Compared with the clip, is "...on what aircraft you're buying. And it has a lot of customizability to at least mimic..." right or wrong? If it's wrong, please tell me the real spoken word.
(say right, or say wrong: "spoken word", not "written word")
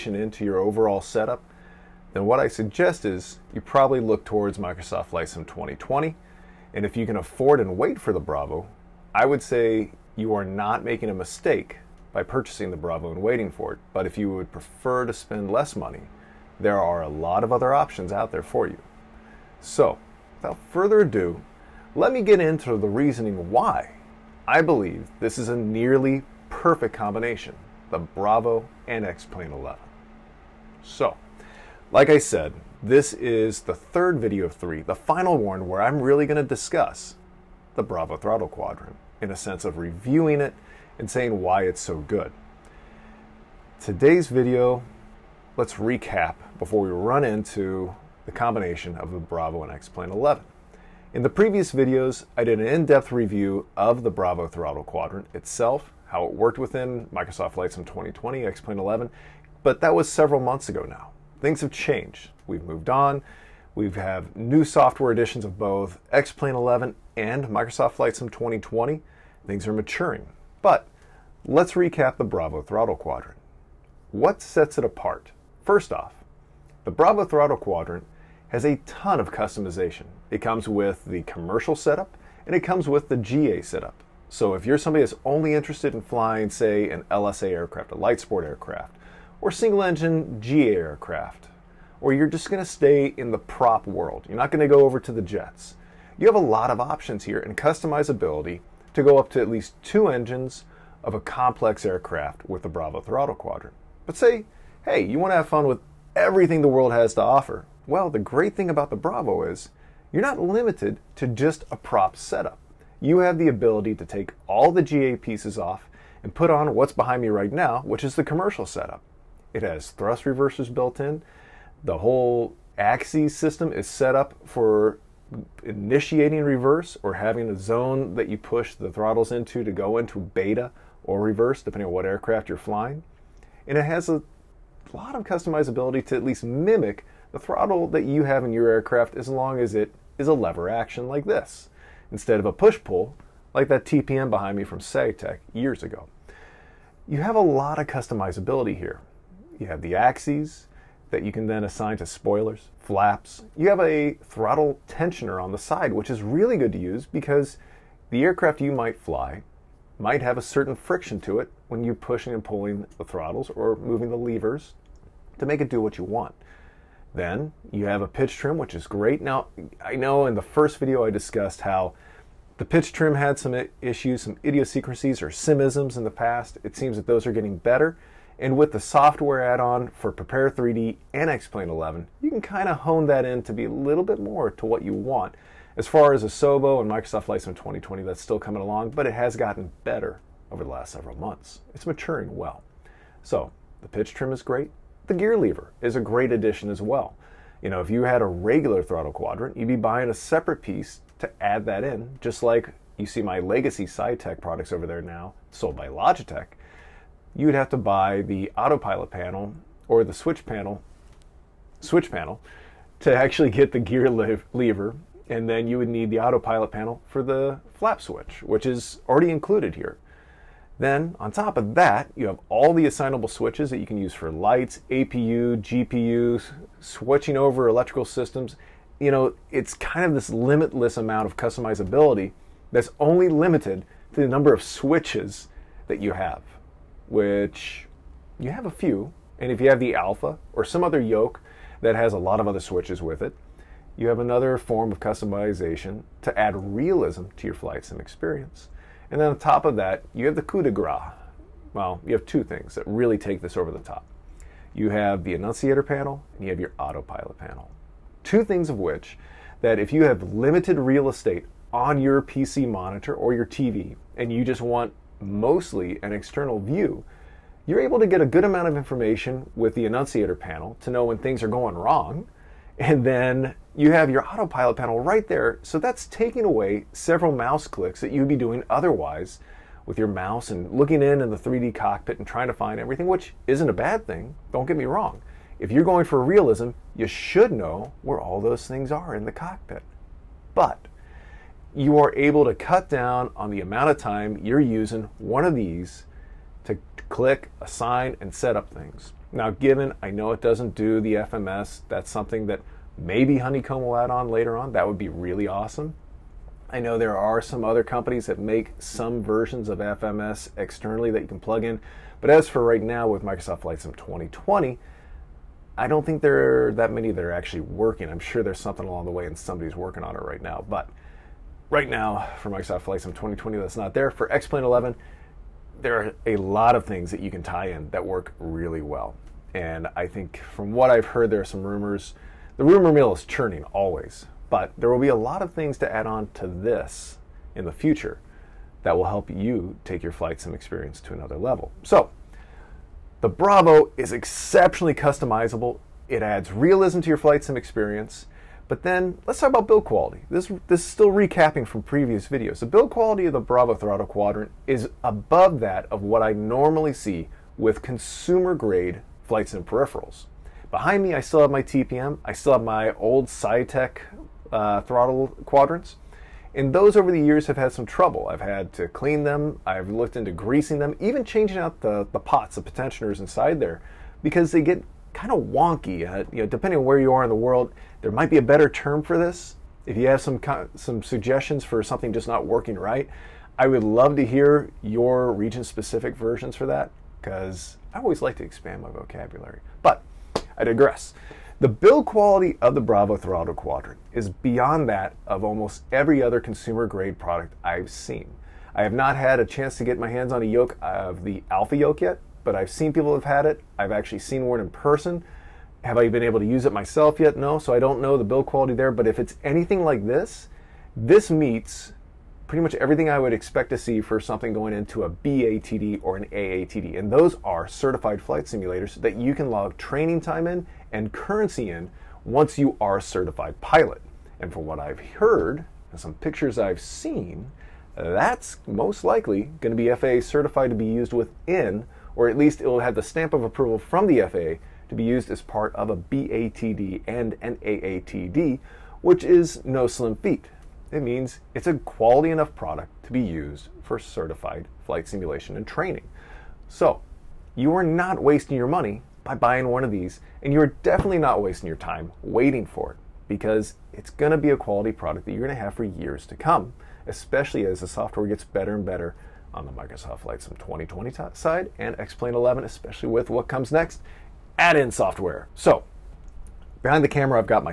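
wrong: "flying", not "buying".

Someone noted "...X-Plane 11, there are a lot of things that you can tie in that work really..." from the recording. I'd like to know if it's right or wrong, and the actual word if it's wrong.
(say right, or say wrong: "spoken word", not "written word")
right.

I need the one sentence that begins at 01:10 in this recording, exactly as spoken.
But let's recap the Bravo throttle quadrant.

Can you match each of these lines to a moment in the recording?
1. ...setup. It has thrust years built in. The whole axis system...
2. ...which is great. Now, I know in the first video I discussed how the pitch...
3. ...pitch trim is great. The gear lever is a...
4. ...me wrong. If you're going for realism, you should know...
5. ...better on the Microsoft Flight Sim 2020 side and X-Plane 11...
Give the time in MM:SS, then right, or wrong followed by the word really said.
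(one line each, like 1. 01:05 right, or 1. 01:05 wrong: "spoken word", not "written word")
1. 01:58 wrong: "reversers", not "years"
2. 02:48 right
3. 03:13 right
4. 04:44 right
5. 07:38 right.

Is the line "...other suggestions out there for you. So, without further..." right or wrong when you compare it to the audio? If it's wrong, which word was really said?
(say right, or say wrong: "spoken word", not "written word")
wrong: "options", not "suggestions".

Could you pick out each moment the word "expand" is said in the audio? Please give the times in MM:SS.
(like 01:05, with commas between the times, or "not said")
06:28.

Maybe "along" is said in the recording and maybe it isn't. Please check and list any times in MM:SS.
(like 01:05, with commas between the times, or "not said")
03:08, 05:18.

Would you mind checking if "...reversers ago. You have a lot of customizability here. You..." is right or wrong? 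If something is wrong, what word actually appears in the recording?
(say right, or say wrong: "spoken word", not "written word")
wrong: "years", not "reversers".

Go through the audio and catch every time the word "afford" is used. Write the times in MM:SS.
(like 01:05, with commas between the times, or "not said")
00:07.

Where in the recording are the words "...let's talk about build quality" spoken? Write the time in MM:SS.
05:49.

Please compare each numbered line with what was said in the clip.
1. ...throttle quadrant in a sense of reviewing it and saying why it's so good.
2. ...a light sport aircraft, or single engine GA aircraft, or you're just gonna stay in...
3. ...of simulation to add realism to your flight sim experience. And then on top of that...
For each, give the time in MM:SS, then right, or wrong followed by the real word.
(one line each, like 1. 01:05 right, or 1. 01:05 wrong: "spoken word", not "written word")
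1. 00:38 right
2. 01:27 right
3. 04:04 wrong: "customization", not "simulation".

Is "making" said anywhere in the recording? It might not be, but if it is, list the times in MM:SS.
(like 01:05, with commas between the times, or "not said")
00:10.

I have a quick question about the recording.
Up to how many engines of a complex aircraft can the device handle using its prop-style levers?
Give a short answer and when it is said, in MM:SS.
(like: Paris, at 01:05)
2, at 01:39.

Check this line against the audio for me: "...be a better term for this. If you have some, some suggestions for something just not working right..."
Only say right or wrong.
right.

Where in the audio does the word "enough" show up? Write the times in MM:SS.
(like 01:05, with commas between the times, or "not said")
07:22.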